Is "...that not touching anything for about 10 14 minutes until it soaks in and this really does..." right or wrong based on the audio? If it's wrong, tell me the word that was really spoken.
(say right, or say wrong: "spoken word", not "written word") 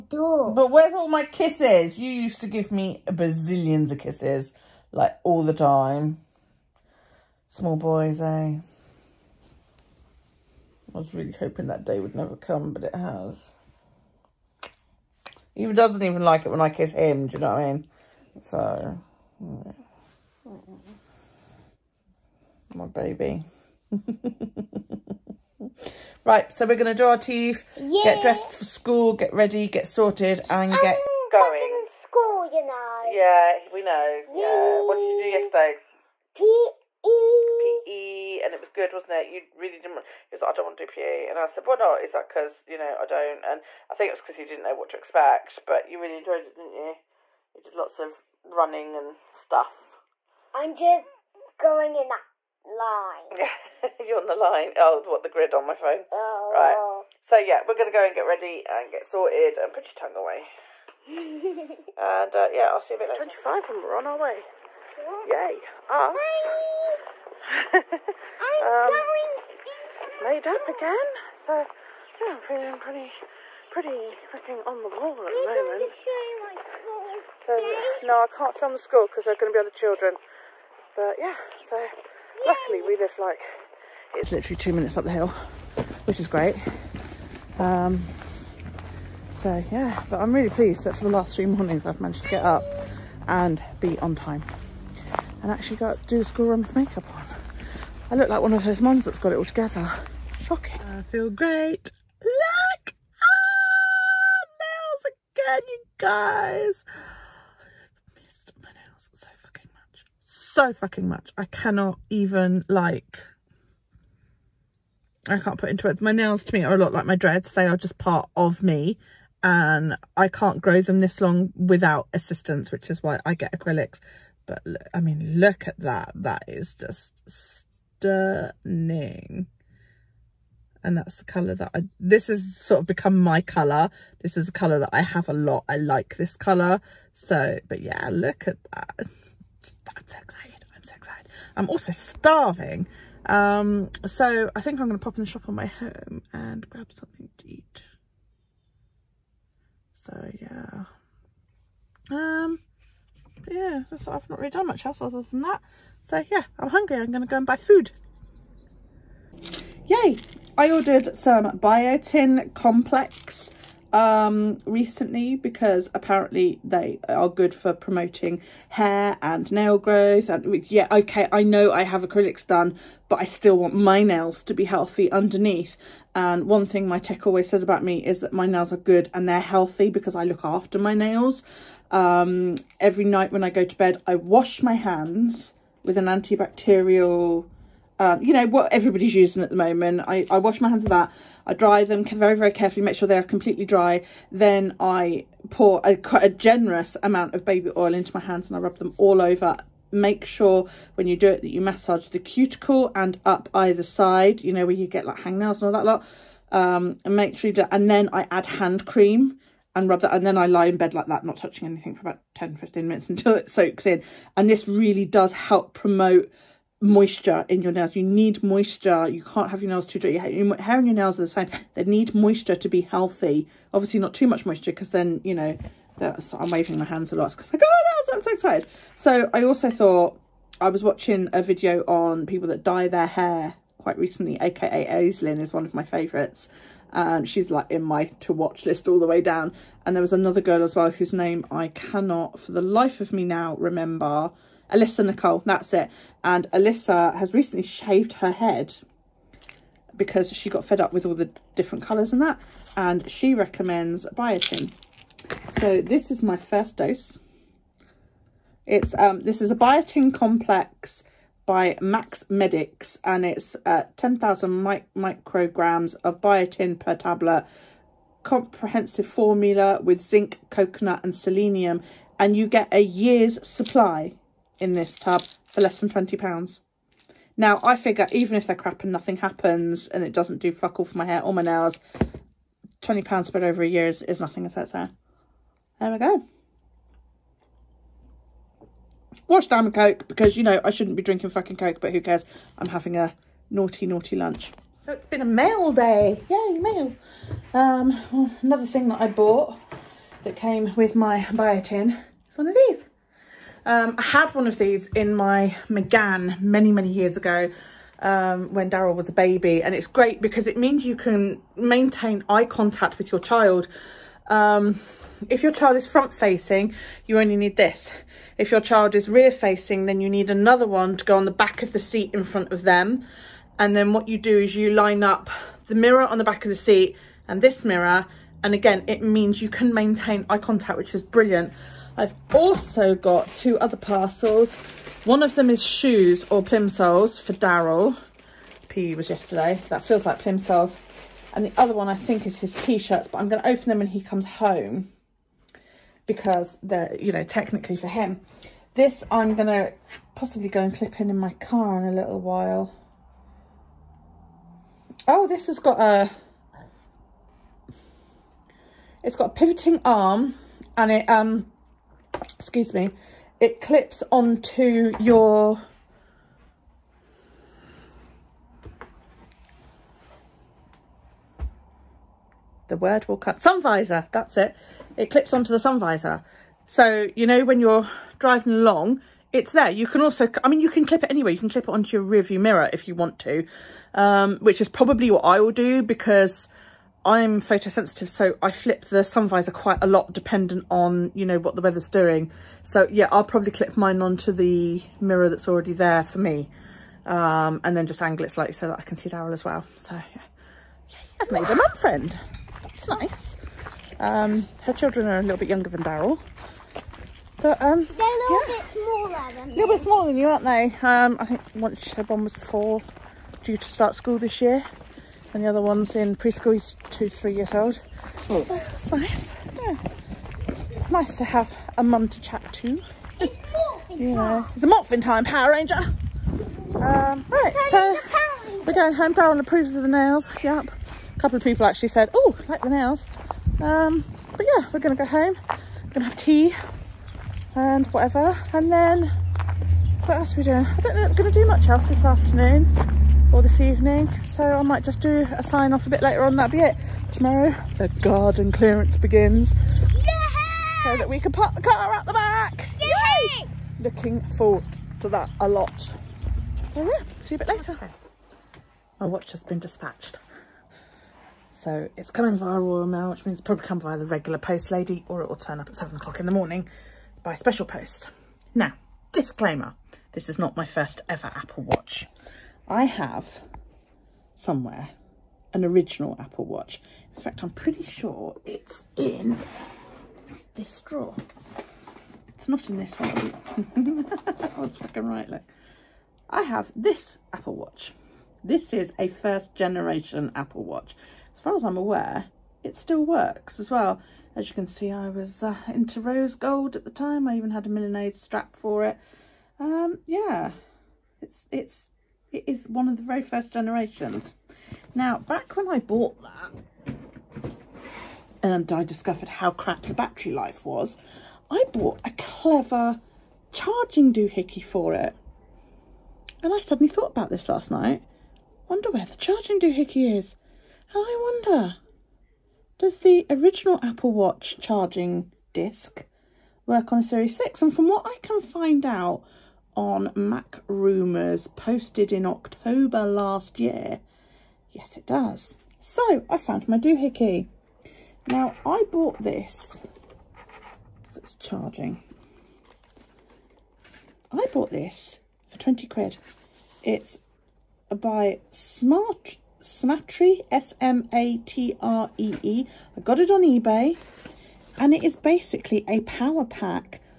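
wrong: "15", not "14".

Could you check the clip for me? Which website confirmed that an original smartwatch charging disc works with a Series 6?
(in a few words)
MacRumors.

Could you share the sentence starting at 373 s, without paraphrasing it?
Sun visor, that's it it clips onto the sun visor.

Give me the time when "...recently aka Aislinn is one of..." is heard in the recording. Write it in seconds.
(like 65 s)
233 s.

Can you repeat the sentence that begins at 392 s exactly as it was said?
So yeah, I'll probably clip mine onto the mirror that's already there for me.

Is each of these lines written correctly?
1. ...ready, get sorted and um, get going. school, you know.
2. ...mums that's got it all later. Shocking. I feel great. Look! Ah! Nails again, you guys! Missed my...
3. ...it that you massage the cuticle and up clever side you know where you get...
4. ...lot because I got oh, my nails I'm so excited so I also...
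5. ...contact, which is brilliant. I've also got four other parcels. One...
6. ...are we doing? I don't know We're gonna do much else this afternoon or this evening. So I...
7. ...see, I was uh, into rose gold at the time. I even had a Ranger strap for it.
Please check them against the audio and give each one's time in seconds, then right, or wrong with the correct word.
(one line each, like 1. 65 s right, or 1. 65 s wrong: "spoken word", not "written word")
1. 29 s right
2. 98 s wrong: "together", not "later"
3. 201 s wrong: "either", not "clever"
4. 227 s right
5. 330 s wrong: "two", not "four"
6. 440 s right
7. 494 s wrong: "Milanese", not "Ranger".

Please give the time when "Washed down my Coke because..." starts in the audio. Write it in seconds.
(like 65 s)
289 s.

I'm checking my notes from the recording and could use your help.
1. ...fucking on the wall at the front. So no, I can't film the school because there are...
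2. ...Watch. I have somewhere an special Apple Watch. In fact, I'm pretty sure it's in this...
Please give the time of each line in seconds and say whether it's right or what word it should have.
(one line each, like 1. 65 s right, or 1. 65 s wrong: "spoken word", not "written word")
1. 74 s wrong: "moment", not "front"
2. 471 s wrong: "original", not "special".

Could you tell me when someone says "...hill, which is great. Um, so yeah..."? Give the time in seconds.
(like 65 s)
85 s.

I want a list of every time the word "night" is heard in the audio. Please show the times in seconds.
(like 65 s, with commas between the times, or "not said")
183 s, 517 s.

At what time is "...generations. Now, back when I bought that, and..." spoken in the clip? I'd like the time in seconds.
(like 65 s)
503 s.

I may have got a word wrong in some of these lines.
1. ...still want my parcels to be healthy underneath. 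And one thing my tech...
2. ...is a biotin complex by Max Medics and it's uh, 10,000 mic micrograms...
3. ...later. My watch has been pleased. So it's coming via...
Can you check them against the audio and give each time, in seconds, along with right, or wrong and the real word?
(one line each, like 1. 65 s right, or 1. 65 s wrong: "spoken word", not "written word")
1. 173 s wrong: "nails", not "parcels"
2. 259 s right
3. 457 s wrong: "dispatched", not "pleased".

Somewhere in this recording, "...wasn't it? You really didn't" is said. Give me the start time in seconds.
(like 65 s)
38 s.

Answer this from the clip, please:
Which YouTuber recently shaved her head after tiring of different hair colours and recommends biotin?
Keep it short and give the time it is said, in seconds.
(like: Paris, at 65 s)
Alyssa Nicole, at 244 s.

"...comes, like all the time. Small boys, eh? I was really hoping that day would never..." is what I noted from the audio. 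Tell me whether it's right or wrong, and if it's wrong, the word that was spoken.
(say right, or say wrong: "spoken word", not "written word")
wrong: "kisses", not "comes".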